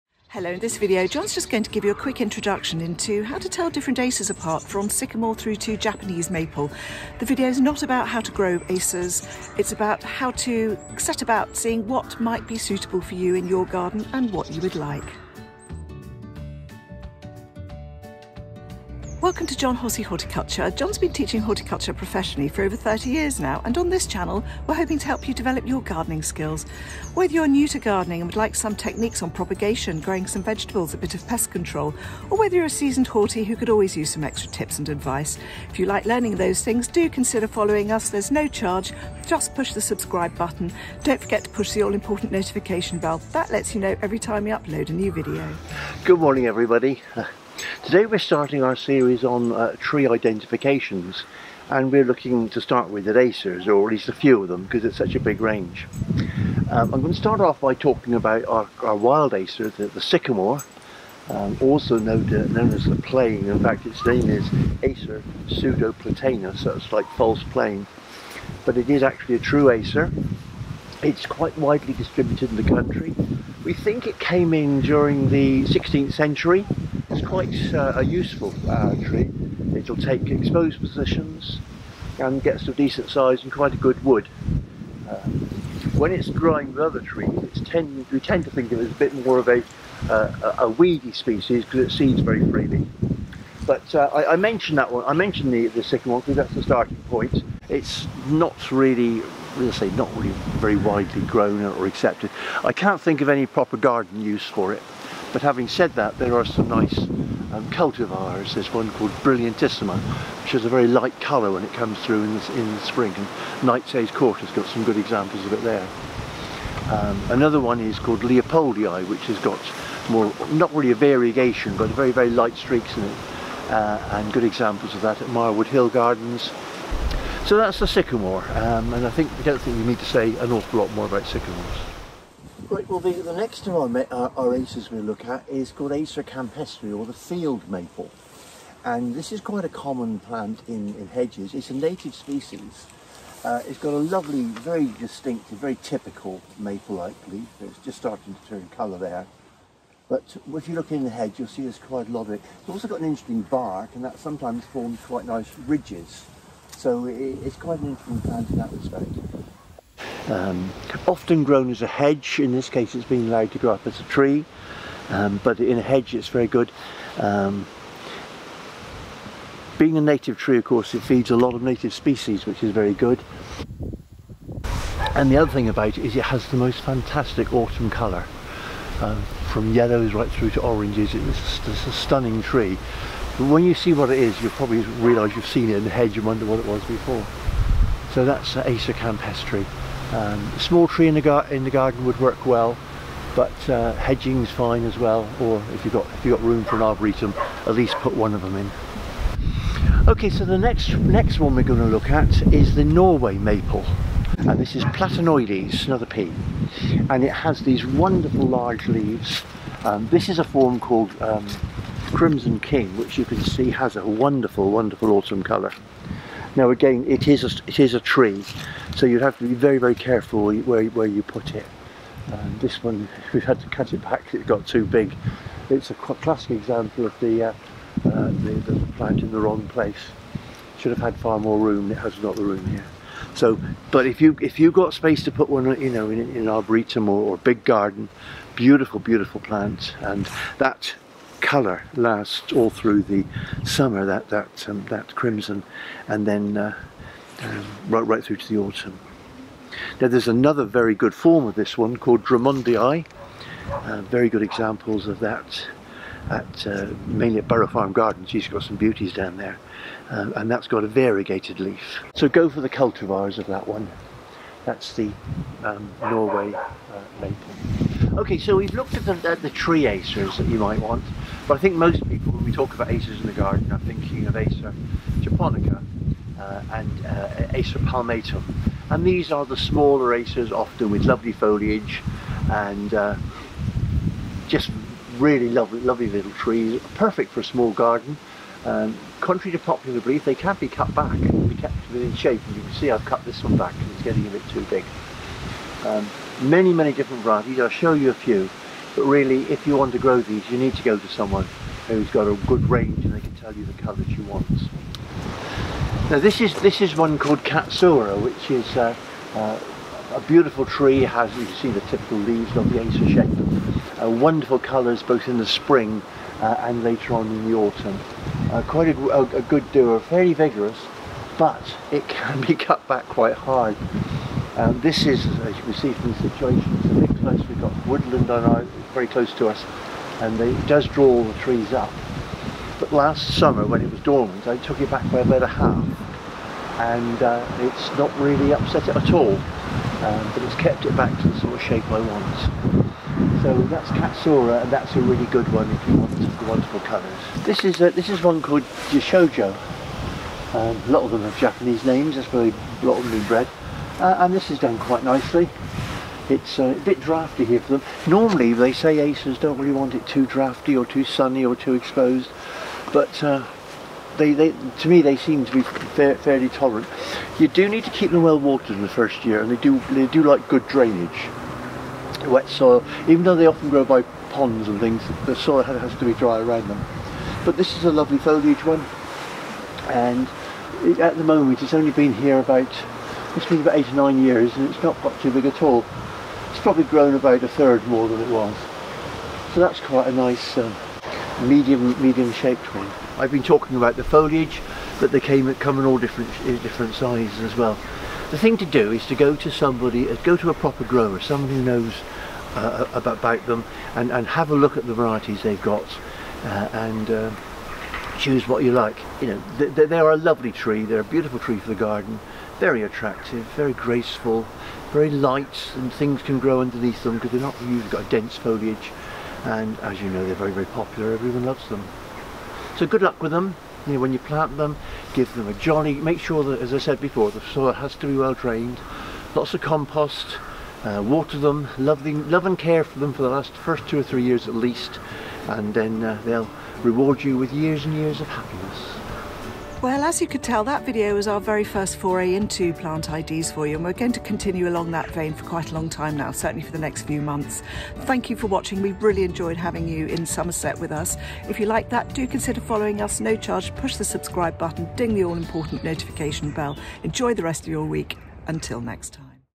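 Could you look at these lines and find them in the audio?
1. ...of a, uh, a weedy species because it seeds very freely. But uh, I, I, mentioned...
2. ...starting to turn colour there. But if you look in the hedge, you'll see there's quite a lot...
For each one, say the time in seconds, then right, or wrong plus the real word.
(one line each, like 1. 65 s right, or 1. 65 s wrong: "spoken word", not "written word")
1. 89 s right
2. 147 s right.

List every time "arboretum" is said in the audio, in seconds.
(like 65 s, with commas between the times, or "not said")
196 s, 236 s.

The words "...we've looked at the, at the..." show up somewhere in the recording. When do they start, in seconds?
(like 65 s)
268 s.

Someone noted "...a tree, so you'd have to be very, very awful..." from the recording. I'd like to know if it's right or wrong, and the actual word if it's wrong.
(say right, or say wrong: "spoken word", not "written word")
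wrong: "careful", not "awful".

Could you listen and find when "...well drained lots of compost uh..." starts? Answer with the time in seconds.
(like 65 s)
428 s.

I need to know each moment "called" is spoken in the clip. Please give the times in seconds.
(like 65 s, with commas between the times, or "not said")
108 s, 117 s, 135 s, 210 s, 251 s, 307 s, 348 s.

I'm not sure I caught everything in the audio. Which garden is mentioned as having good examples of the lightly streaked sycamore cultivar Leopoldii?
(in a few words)
Marwood Hill Gardens.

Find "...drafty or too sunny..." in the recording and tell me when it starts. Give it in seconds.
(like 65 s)
360 s.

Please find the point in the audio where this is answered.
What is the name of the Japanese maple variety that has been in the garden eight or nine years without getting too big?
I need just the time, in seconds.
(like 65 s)
348 s.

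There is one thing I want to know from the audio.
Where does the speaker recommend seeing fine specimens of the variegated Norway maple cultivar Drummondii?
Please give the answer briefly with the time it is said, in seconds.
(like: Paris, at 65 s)
Burrow Farm Gardens, at 257 s.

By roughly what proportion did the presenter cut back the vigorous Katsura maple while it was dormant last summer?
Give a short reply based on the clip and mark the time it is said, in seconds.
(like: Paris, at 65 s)
about a half, at 335 s.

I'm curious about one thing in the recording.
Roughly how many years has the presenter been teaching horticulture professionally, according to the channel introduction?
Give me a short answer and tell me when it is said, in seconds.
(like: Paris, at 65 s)
over 30 years, at 22 s.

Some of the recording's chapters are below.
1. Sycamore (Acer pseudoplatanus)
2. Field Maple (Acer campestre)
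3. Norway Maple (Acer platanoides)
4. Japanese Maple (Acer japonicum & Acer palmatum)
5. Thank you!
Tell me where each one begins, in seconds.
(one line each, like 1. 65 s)
1. 46 s
2. 132 s
3. 202 s
4. 269 s
5. 439 s.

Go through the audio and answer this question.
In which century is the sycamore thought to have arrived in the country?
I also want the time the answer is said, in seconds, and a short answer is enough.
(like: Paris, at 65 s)
16th century, at 75 s.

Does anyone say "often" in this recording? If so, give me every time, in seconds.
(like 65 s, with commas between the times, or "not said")
161 s, 280 s, 373 s.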